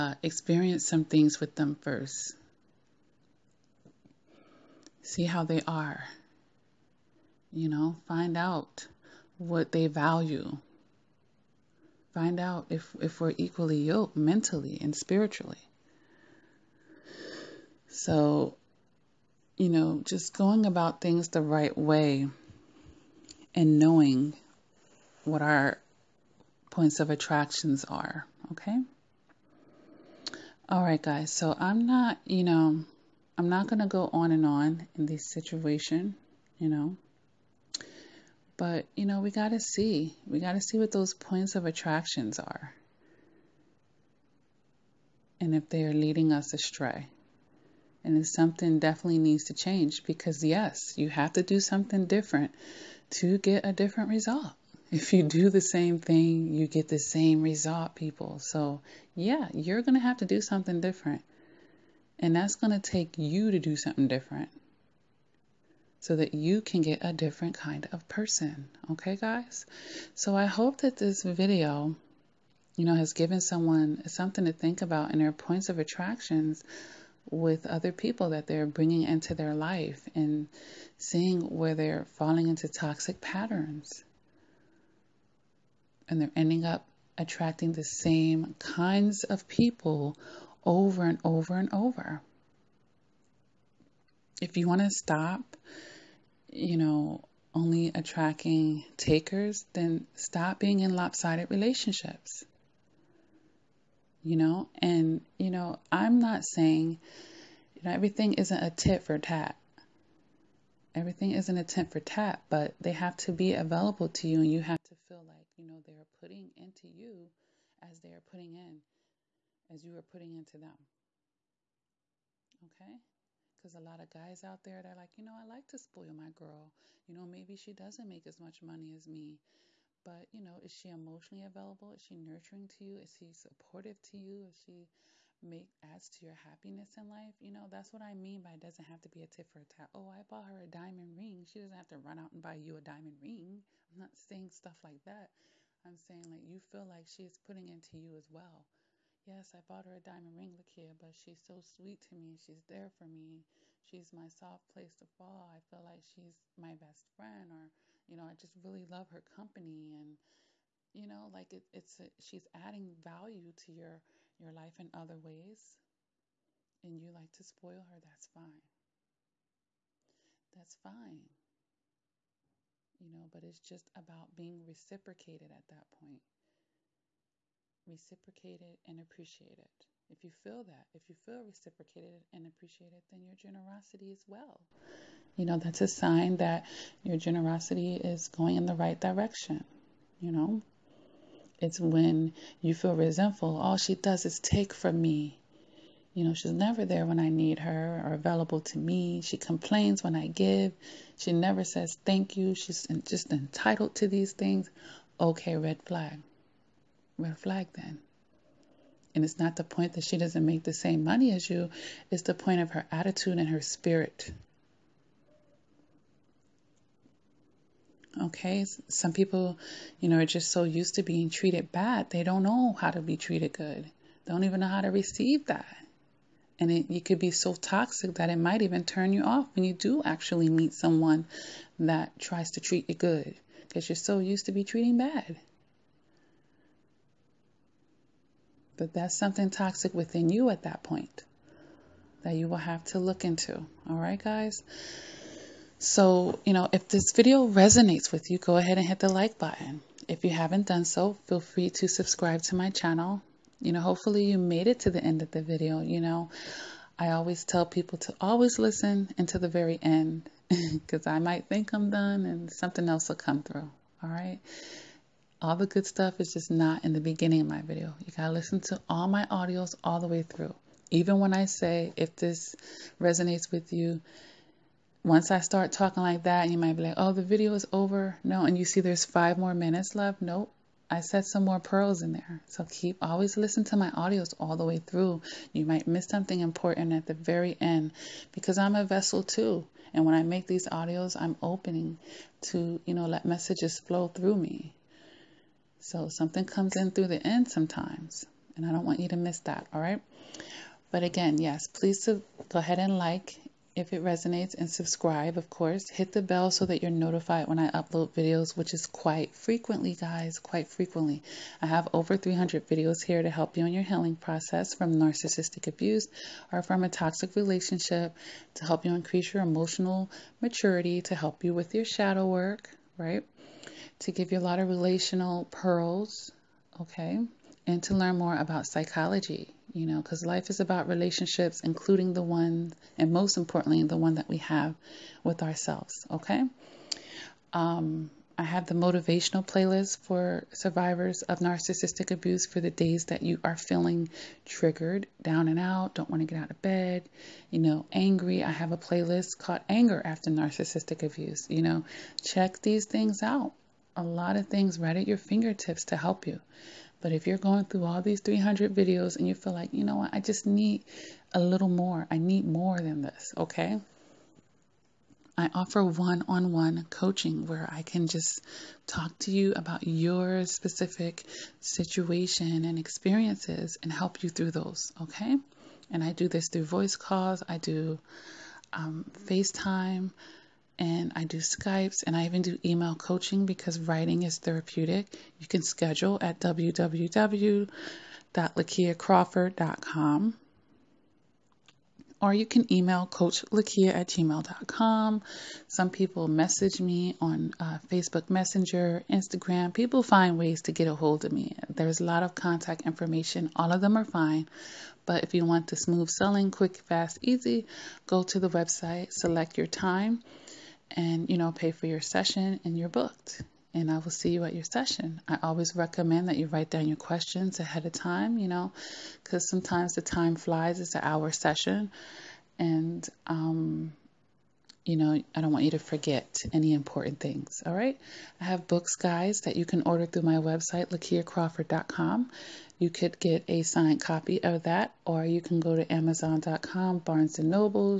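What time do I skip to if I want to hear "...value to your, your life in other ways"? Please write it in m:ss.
2:42.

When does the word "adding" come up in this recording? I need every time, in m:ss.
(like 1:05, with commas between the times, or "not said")
2:42.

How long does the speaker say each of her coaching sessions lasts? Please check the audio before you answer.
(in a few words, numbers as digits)
1 hour.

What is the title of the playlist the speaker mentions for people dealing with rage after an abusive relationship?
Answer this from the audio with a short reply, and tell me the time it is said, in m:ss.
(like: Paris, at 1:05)
Anger After Narcissistic Abuse, at 5:49.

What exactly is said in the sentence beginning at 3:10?
You know, it's when you feel resentful, all she does is take from me.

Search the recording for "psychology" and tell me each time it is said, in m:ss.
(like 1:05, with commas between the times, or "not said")
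5:28.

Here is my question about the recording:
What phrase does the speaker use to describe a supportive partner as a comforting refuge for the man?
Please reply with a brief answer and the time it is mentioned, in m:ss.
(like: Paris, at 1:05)
soft place to fall, at 2:34.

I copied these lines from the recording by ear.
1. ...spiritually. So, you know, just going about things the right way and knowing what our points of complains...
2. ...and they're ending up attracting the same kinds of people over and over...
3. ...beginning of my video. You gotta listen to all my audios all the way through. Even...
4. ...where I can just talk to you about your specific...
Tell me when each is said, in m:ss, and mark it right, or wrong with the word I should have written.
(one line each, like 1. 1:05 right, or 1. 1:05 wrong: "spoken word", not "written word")
1. 0:14 wrong: "attractions", not "complains"
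2. 1:26 right
3. 4:26 right
4. 6:07 right.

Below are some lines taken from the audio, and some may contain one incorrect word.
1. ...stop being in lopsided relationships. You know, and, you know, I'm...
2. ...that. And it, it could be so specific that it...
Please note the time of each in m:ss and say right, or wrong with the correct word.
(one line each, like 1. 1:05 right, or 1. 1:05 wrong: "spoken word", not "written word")
1. 1:40 right
2. 3:45 wrong: "toxic", not "specific".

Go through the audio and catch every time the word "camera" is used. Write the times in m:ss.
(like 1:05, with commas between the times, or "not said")
not said.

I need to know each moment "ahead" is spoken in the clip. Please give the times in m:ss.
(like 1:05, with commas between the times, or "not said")
4:08, 5:02, 6:57.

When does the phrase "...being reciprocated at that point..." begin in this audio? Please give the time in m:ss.
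2:54.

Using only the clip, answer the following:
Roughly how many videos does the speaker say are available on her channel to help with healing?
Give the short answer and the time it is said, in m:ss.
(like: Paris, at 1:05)
300, at 5:11.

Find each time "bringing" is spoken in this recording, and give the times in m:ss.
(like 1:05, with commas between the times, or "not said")
1:18.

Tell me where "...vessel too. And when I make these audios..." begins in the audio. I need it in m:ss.
4:48.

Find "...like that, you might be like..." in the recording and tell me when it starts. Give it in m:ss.
4:36.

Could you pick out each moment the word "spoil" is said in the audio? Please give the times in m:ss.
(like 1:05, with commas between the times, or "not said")
2:05, 2:47.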